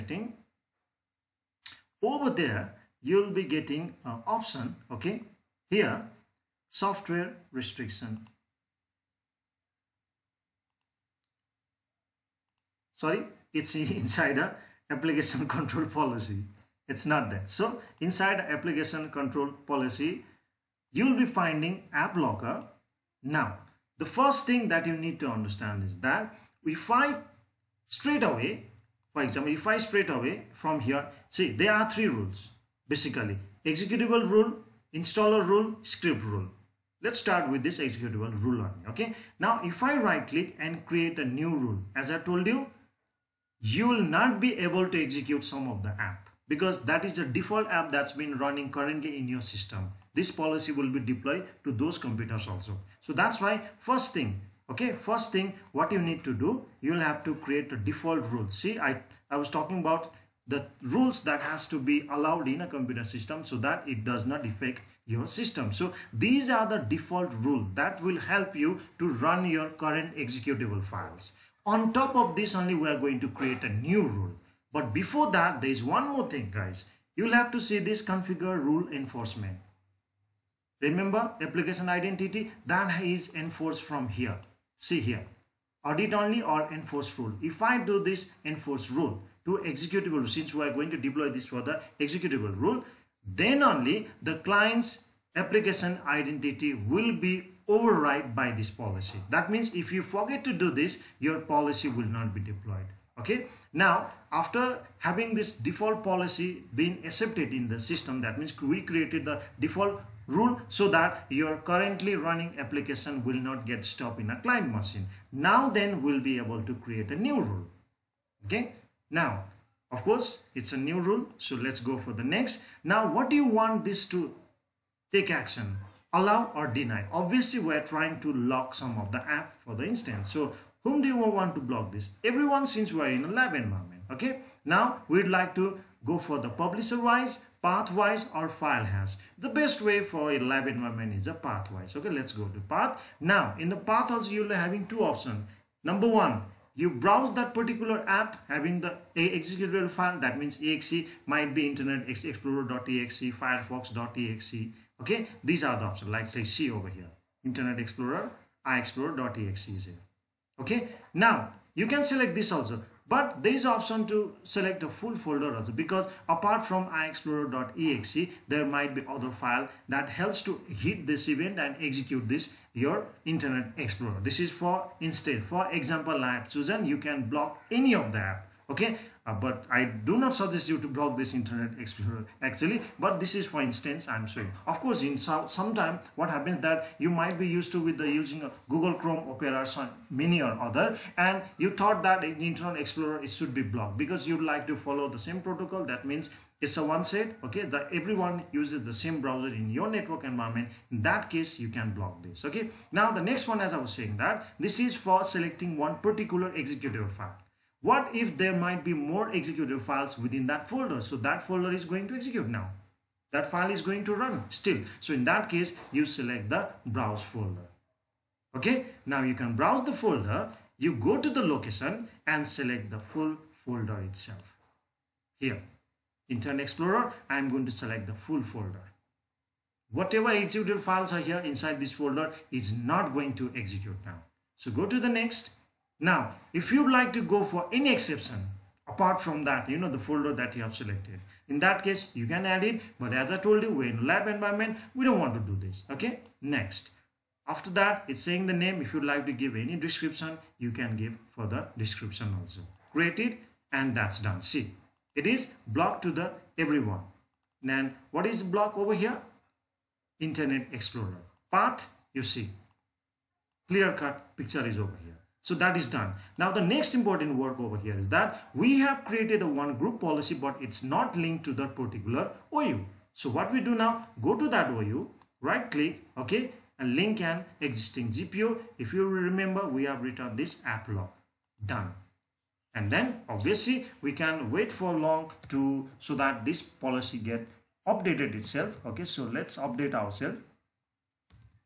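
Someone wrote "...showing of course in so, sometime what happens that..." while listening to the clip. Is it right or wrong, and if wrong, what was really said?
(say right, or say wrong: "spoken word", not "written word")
right.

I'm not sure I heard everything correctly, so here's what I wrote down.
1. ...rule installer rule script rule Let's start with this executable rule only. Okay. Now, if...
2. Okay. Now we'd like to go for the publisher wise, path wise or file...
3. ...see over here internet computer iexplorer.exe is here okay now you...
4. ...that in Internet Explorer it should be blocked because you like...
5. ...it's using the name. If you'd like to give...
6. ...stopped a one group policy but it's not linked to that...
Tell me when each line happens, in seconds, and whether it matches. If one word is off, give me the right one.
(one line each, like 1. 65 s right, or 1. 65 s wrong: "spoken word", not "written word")
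1. 34 s right
2. 134 s right
3. 156 s wrong: "explorer", not "computer"
4. 192 s right
5. 248 s wrong: "saying", not "using"
6. 269 s wrong: "created", not "stopped".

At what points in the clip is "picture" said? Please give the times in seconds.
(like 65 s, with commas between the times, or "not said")
264 s.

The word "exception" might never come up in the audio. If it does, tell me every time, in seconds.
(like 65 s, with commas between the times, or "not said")
237 s.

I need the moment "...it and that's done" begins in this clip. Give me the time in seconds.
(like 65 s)
253 s.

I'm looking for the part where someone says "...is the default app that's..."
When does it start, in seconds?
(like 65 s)
47 s.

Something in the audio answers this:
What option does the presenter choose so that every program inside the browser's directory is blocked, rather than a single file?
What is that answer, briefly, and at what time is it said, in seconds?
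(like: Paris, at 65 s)
Browse folder, at 216 s.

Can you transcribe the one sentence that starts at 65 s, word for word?
So these are the default rule that will help you to run your current executable files.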